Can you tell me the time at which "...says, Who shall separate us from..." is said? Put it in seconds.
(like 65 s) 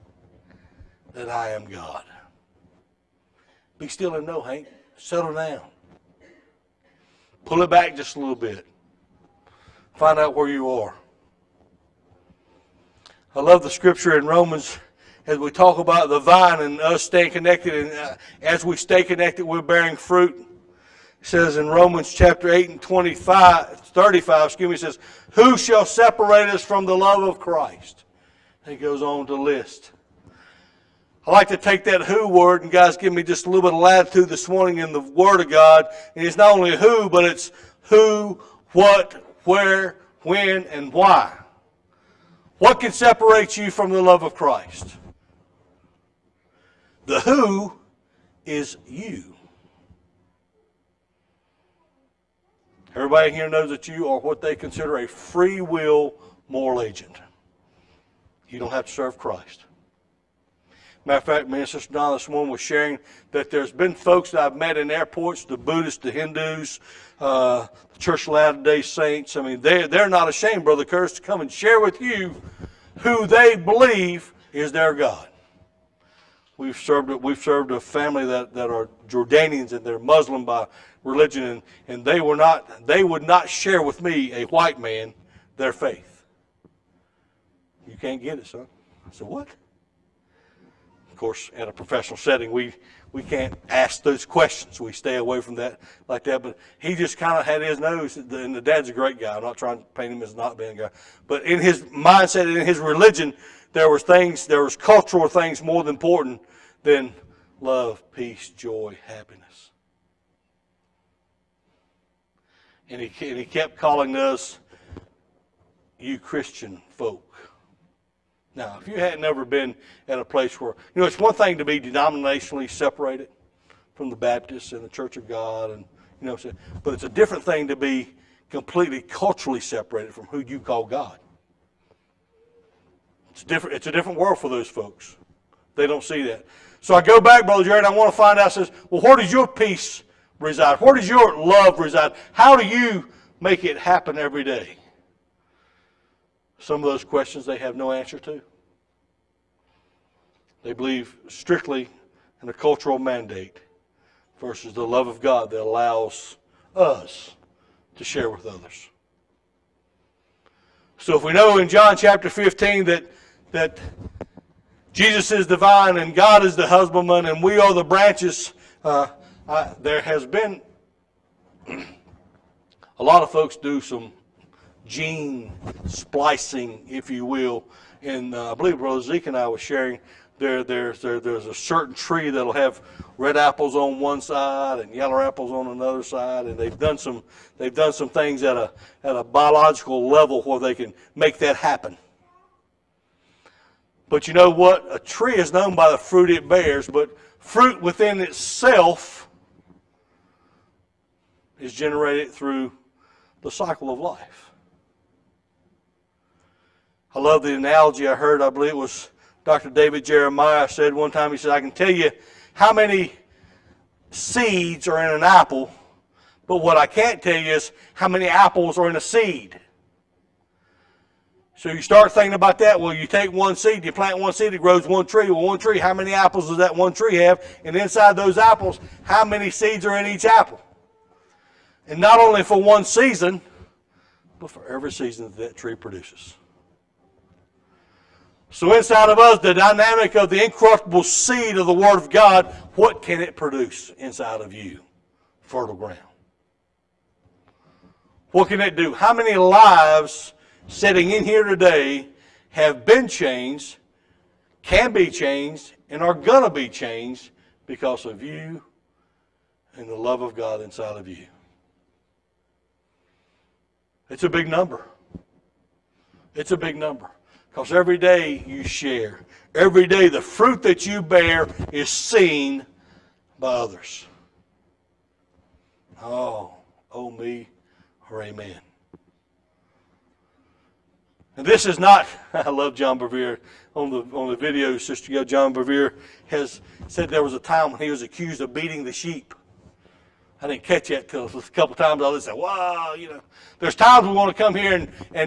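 24 s.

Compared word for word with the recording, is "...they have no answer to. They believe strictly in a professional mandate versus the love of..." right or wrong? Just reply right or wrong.
wrong.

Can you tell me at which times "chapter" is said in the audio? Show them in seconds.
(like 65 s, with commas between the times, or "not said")
22 s, 161 s.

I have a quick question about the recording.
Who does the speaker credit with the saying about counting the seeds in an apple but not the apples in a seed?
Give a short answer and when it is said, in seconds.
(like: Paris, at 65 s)
David Jeremiah, at 209 s.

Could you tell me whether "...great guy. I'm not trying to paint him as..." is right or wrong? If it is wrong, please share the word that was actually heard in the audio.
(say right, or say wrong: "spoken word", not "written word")
right.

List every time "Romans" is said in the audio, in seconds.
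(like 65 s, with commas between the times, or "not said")
14 s, 21 s.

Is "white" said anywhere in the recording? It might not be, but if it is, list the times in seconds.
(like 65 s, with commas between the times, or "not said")
84 s.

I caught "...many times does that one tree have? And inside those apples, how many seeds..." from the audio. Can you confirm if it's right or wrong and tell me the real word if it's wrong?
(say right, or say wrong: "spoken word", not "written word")
wrong: "apples", not "times".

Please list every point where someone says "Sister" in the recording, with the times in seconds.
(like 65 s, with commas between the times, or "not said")
61 s, 284 s.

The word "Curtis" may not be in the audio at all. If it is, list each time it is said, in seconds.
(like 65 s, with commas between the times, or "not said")
70 s.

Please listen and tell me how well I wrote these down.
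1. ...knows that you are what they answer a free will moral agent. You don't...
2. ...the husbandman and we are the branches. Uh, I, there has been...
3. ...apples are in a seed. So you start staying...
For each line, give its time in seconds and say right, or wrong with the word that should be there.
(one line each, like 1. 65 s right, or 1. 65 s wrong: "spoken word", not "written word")
1. 53 s wrong: "consider", not "answer"
2. 166 s right
3. 218 s wrong: "thinking", not "staying".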